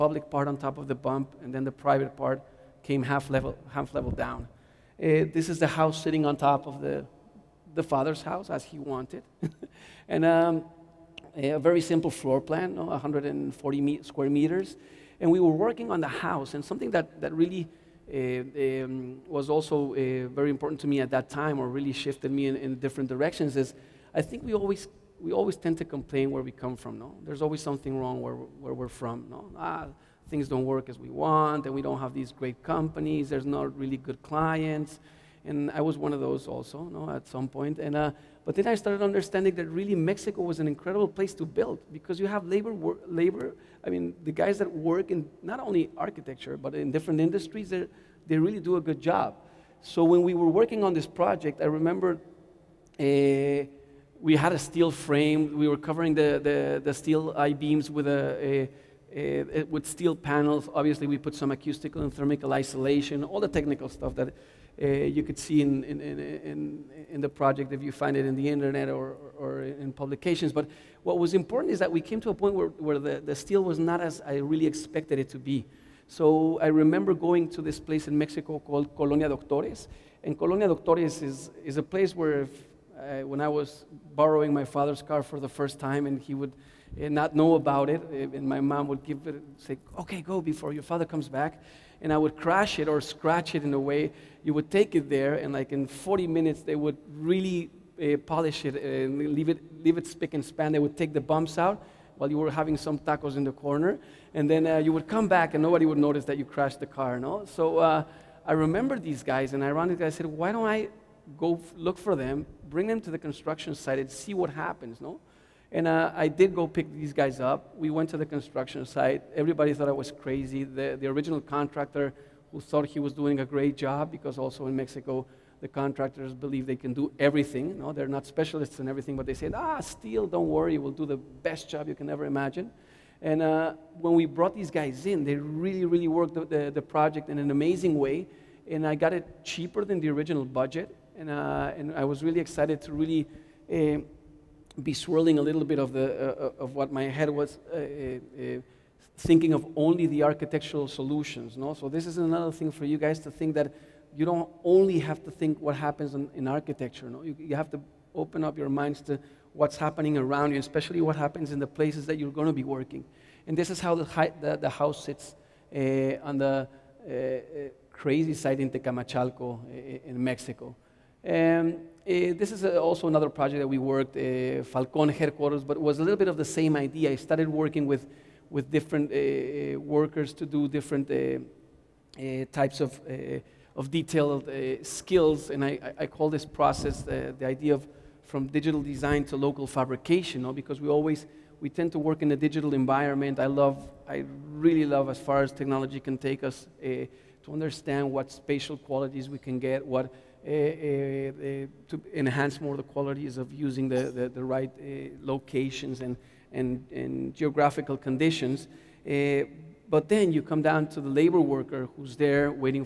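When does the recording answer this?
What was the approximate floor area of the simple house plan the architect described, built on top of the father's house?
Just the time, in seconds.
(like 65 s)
12 s.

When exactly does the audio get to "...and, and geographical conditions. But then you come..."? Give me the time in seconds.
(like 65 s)
206 s.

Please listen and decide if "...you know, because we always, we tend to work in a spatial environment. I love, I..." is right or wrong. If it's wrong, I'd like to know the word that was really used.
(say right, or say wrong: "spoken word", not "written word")
wrong: "digital", not "spatial".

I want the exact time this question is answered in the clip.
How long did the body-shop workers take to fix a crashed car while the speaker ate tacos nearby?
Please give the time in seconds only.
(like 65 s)
95 s.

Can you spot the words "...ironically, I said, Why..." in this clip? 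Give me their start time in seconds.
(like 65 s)
109 s.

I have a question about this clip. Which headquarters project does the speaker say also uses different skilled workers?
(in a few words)
Falcon Headquarters.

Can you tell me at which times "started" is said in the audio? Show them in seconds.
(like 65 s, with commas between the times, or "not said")
38 s, 177 s.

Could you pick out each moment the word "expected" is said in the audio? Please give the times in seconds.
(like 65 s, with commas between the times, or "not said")
74 s.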